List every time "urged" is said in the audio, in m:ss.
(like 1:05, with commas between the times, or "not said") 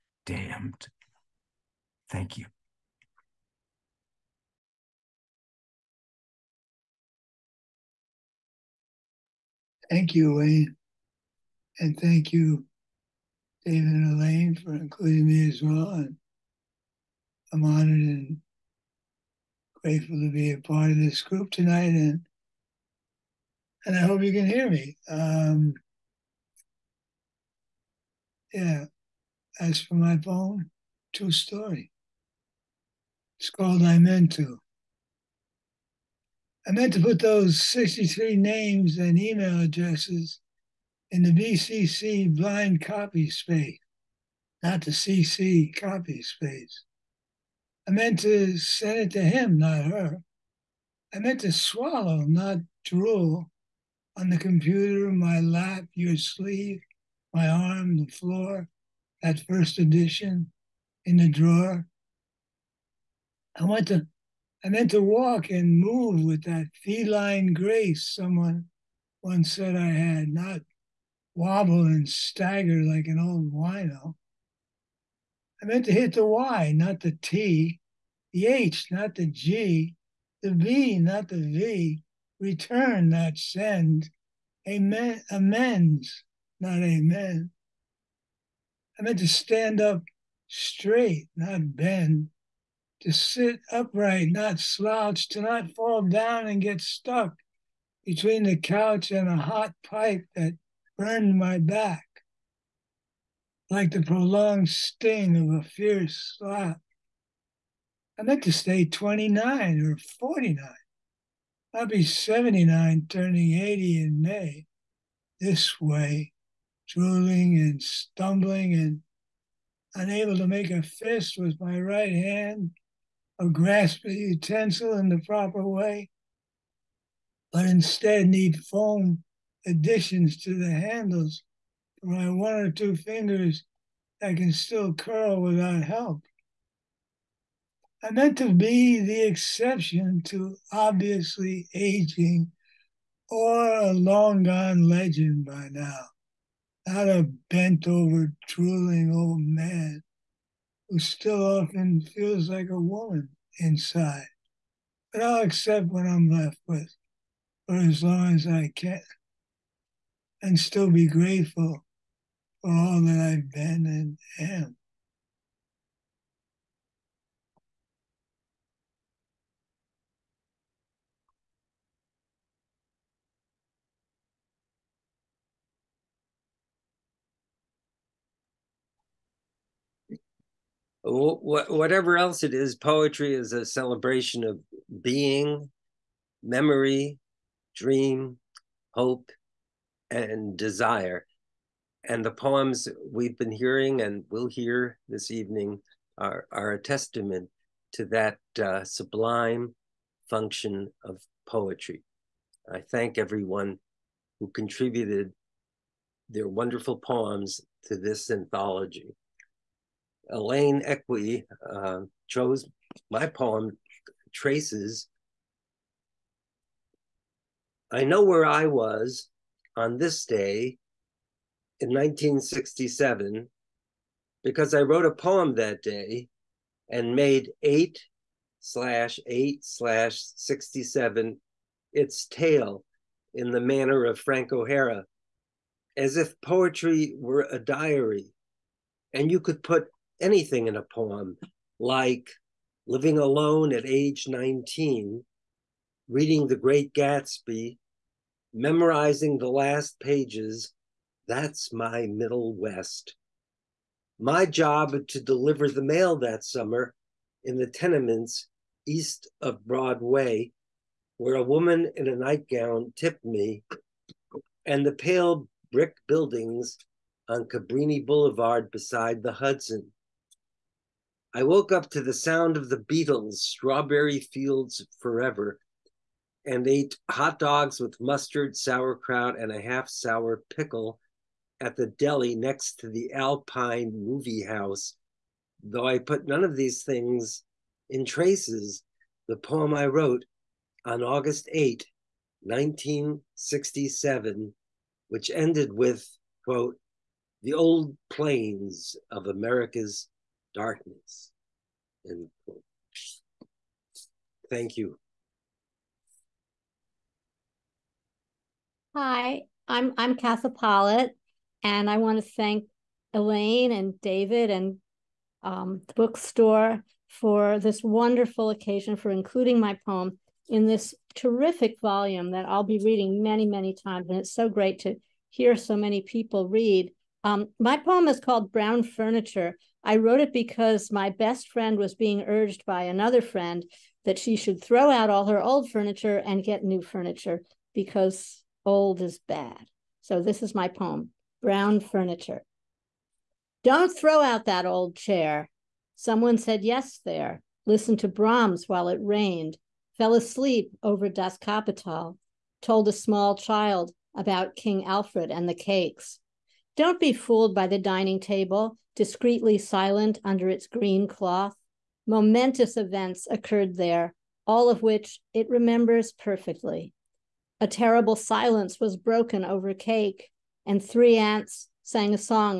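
5:32.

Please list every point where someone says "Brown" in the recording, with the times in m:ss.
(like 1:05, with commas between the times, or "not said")
5:28, 5:41.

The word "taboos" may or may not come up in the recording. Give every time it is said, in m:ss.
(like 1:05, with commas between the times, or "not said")
not said.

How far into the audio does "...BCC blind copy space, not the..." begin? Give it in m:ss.
0:41.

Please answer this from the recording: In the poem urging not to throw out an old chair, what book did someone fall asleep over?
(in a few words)
Das Kapital.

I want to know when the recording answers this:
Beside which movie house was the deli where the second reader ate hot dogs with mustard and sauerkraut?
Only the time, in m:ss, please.
4:43.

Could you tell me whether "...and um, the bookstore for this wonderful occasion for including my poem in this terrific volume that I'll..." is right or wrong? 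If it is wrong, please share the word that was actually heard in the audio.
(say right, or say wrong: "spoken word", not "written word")
right.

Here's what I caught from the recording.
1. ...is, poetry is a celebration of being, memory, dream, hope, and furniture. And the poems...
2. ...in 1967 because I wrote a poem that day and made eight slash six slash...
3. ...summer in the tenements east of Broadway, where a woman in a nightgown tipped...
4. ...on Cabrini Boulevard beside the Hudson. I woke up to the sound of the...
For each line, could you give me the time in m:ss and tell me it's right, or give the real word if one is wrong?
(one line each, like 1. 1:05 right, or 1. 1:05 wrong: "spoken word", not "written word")
1. 3:02 wrong: "desire", not "furniture"
2. 3:41 wrong: "eight", not "six"
3. 4:16 right
4. 4:27 right.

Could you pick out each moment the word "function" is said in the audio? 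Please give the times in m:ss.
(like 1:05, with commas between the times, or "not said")
3:20.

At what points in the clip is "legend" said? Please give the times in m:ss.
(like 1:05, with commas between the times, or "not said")
2:24.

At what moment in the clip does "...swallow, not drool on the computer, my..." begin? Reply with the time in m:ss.
0:51.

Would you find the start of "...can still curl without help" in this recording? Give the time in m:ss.
2:14.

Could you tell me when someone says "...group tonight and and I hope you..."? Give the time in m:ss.
0:21.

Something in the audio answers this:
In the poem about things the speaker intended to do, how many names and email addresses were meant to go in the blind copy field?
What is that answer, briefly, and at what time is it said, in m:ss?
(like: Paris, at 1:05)
63, at 0:37.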